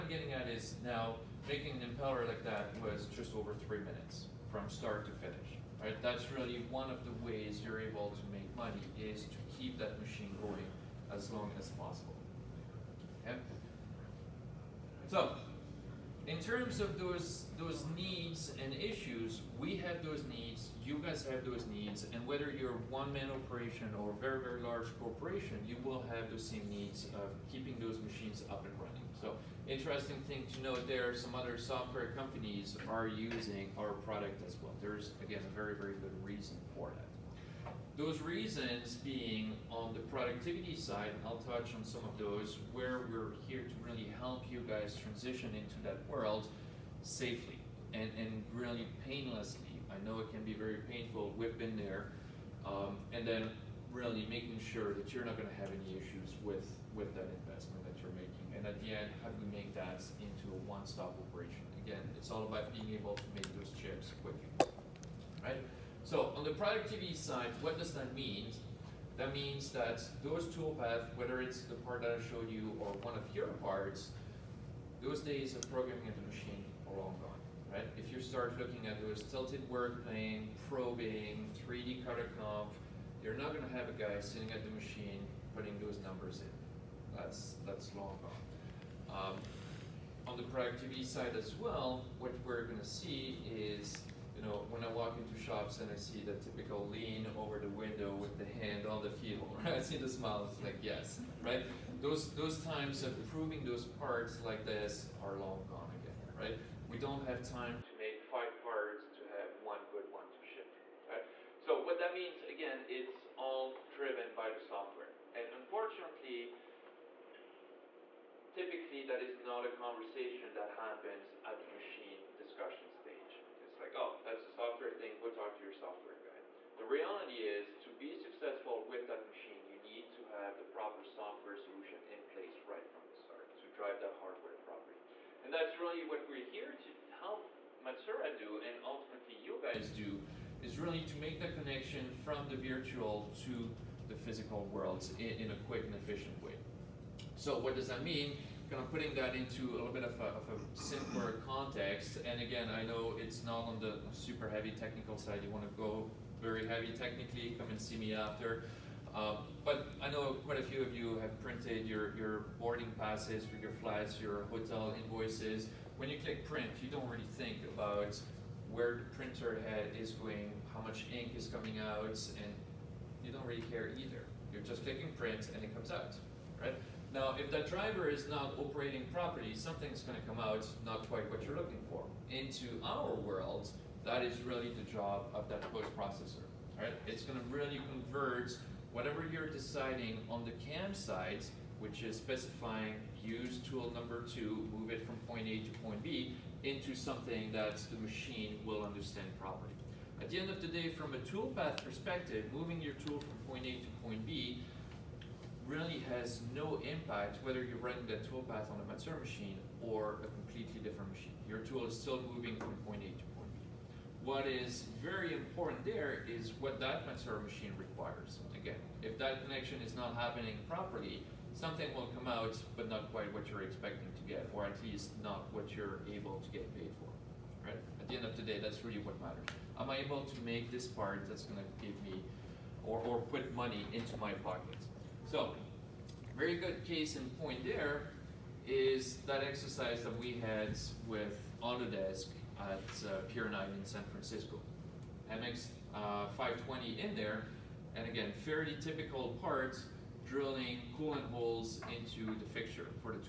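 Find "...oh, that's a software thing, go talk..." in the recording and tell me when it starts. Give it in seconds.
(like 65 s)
123 s.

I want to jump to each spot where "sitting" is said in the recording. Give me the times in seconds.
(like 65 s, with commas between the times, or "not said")
84 s.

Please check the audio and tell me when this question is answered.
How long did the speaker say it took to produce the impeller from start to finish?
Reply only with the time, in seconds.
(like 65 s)
3 s.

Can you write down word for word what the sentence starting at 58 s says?
And at the end, how do we make that into a one-stop operation?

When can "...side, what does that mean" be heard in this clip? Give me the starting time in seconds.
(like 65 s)
67 s.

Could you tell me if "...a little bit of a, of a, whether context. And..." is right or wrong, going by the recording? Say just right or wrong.
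wrong.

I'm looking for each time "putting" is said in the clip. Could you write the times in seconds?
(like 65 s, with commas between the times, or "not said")
85 s, 148 s.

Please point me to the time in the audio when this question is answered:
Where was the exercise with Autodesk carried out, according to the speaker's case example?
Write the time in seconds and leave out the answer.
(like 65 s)
243 s.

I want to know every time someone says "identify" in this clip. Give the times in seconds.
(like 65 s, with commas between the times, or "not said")
not said.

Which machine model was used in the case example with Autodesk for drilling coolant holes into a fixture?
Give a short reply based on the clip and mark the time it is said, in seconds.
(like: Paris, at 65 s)
MX 520, at 245 s.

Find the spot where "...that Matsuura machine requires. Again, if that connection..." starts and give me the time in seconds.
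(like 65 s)
216 s.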